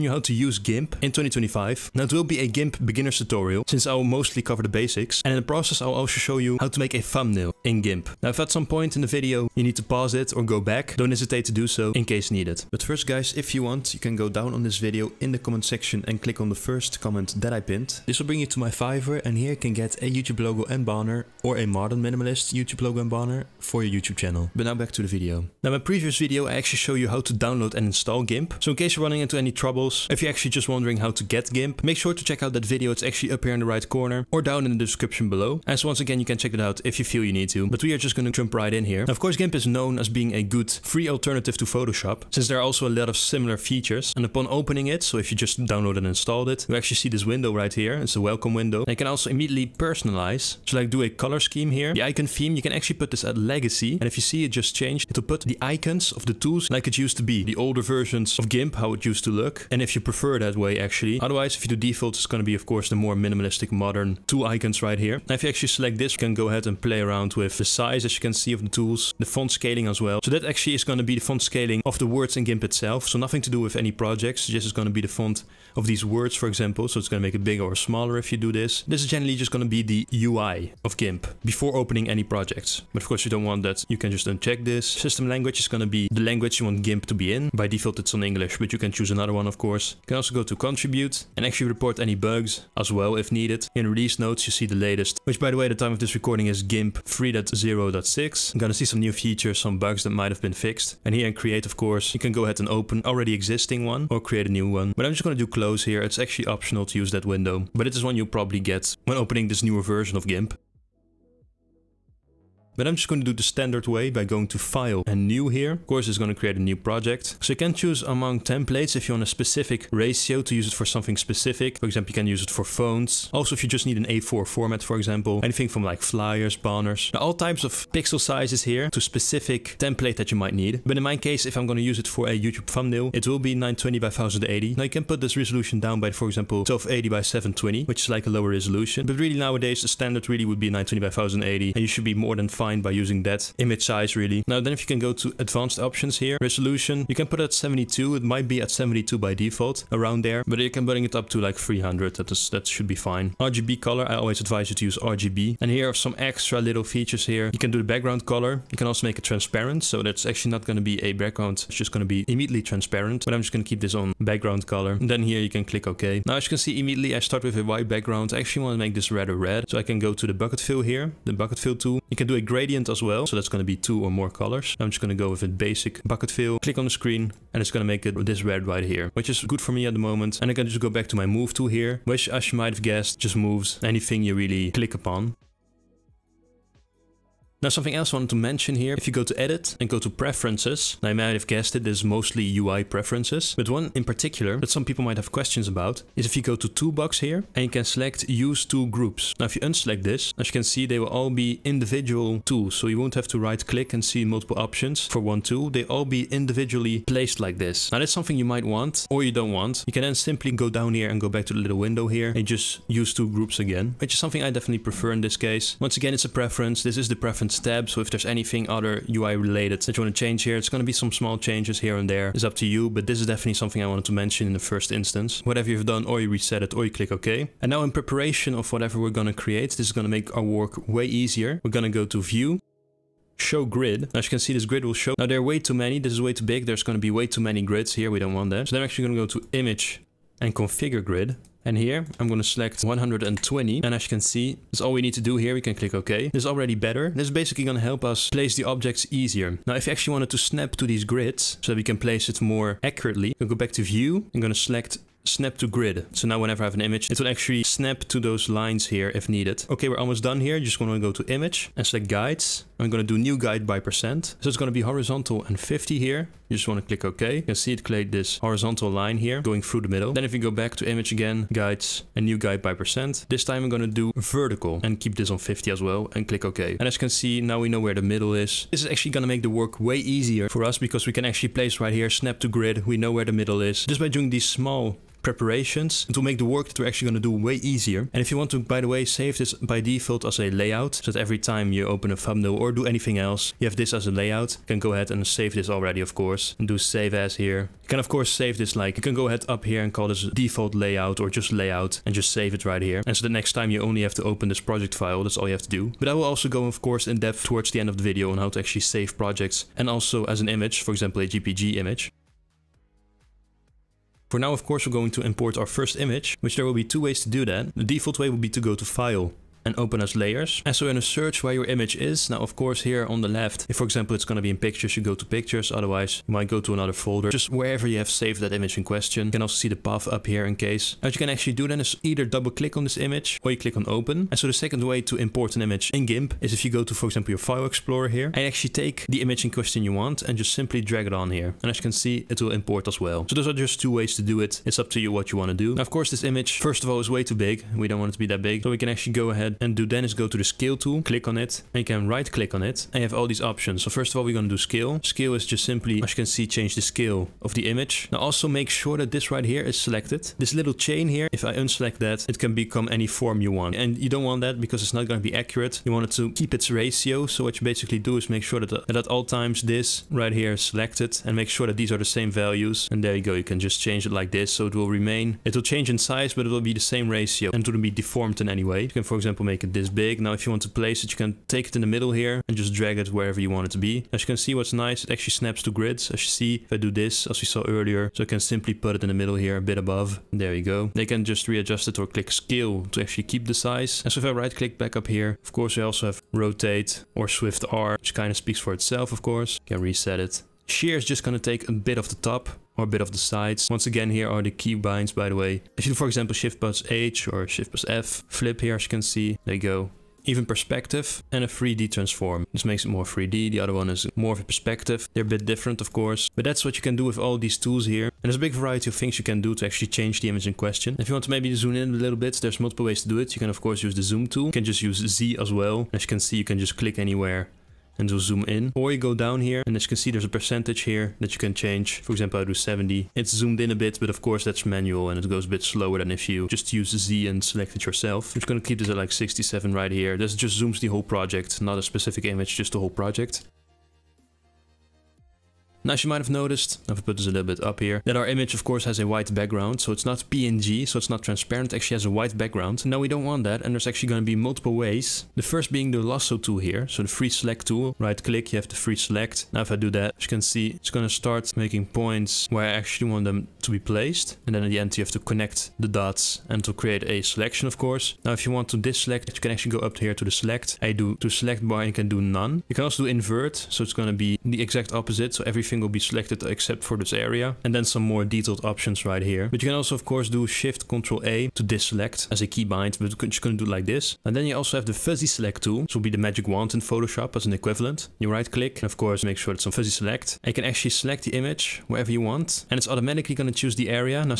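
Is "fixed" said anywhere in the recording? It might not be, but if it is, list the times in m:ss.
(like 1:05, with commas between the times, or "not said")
1:40.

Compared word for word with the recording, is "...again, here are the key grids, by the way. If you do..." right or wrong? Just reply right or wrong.
wrong.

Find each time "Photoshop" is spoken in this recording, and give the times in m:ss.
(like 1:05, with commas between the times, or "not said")
0:41, 8:06.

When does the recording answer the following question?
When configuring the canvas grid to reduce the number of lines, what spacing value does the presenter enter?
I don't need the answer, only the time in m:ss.
4:02.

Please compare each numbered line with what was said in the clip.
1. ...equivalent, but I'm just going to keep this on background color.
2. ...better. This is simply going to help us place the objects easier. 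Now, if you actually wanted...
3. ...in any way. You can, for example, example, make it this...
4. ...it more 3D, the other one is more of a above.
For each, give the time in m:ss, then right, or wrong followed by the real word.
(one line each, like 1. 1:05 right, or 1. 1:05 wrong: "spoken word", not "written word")
1. 2:42 wrong: "transparent", not "equivalent"
2. 4:06 wrong: "basically", not "simply"
3. 6:18 right
4. 6:52 wrong: "perspective", not "above".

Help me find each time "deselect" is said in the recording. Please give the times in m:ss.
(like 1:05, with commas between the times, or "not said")
7:48, 8:01.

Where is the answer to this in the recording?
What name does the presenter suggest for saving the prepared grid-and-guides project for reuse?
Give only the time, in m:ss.
5:00.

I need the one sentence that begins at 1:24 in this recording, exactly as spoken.
System language is going to be the language you want GIMP to be in.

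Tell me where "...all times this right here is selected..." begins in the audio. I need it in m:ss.
6:09.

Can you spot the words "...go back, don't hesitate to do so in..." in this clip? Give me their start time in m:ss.
0:10.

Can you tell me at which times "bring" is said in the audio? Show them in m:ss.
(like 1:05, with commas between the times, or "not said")
0:18, 2:30.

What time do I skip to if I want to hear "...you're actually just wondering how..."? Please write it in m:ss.
0:30.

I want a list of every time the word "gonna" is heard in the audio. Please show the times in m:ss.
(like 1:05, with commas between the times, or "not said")
1:38, 1:45, 7:18.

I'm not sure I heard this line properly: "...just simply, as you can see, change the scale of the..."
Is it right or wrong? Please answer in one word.
right.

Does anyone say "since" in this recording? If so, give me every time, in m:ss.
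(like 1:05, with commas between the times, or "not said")
0:03, 0:42.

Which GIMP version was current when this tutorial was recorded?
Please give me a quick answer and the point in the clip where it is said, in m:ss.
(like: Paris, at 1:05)
3.0.6, at 1:36.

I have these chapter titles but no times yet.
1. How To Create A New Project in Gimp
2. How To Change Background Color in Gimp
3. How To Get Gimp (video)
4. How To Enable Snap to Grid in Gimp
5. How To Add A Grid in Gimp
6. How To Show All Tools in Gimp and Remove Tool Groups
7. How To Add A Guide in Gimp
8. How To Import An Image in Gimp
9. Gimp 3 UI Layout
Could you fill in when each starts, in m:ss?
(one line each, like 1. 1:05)
1. 1:50
2. 2:46
3. 0:25
4. 4:09
5. 3:47
6. 3:05
7. 4:19
8. 5:11
9. 0:37.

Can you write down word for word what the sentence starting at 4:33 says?
This time I'm going to do vertical and keep this on 50 as well and click OK.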